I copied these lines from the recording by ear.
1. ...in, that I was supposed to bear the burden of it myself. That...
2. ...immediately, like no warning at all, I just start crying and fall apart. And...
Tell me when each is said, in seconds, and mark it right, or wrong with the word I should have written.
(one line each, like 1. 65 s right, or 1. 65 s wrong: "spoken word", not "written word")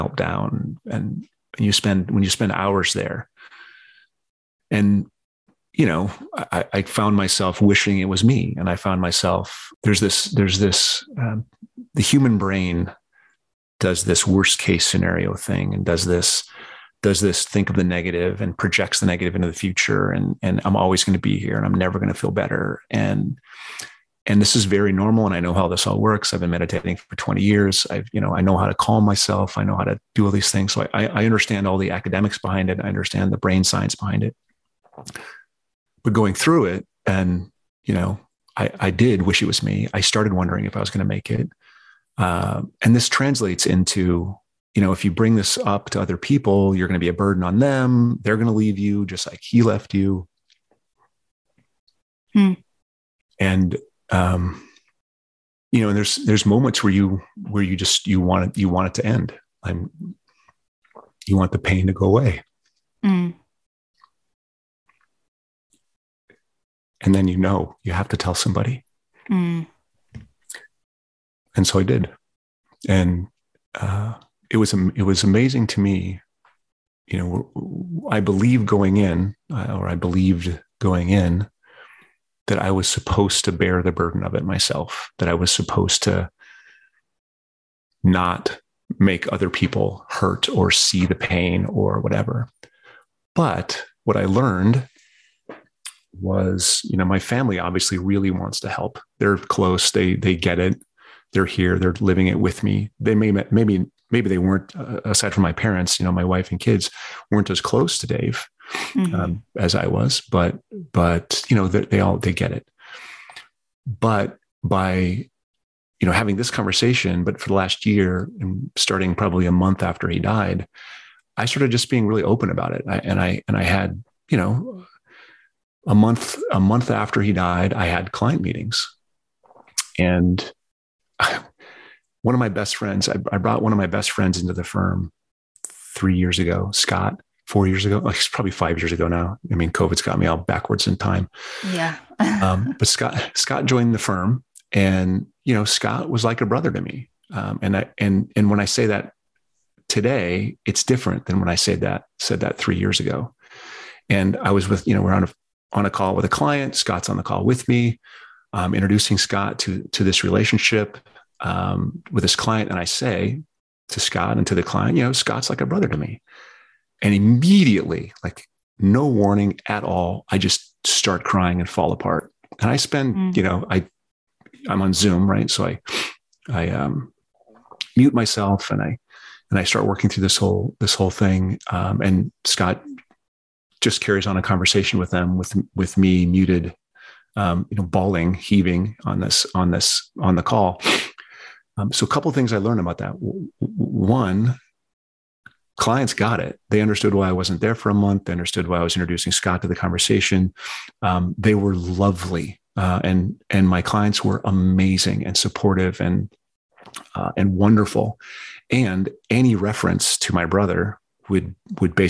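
1. 81 s right
2. 167 s right.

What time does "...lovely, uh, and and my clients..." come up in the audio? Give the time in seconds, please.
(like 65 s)
201 s.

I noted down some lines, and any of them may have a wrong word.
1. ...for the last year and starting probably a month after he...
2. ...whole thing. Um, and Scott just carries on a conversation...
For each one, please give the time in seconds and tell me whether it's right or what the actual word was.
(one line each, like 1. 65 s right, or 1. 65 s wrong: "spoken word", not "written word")
1. 117 s right
2. 180 s right.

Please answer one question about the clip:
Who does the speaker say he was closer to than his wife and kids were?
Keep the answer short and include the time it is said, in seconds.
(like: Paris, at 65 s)
Dave, at 108 s.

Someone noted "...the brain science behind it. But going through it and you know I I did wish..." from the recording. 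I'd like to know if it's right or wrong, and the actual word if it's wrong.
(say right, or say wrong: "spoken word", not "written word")
right.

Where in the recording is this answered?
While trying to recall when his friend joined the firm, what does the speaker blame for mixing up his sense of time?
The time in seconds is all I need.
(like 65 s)
139 s.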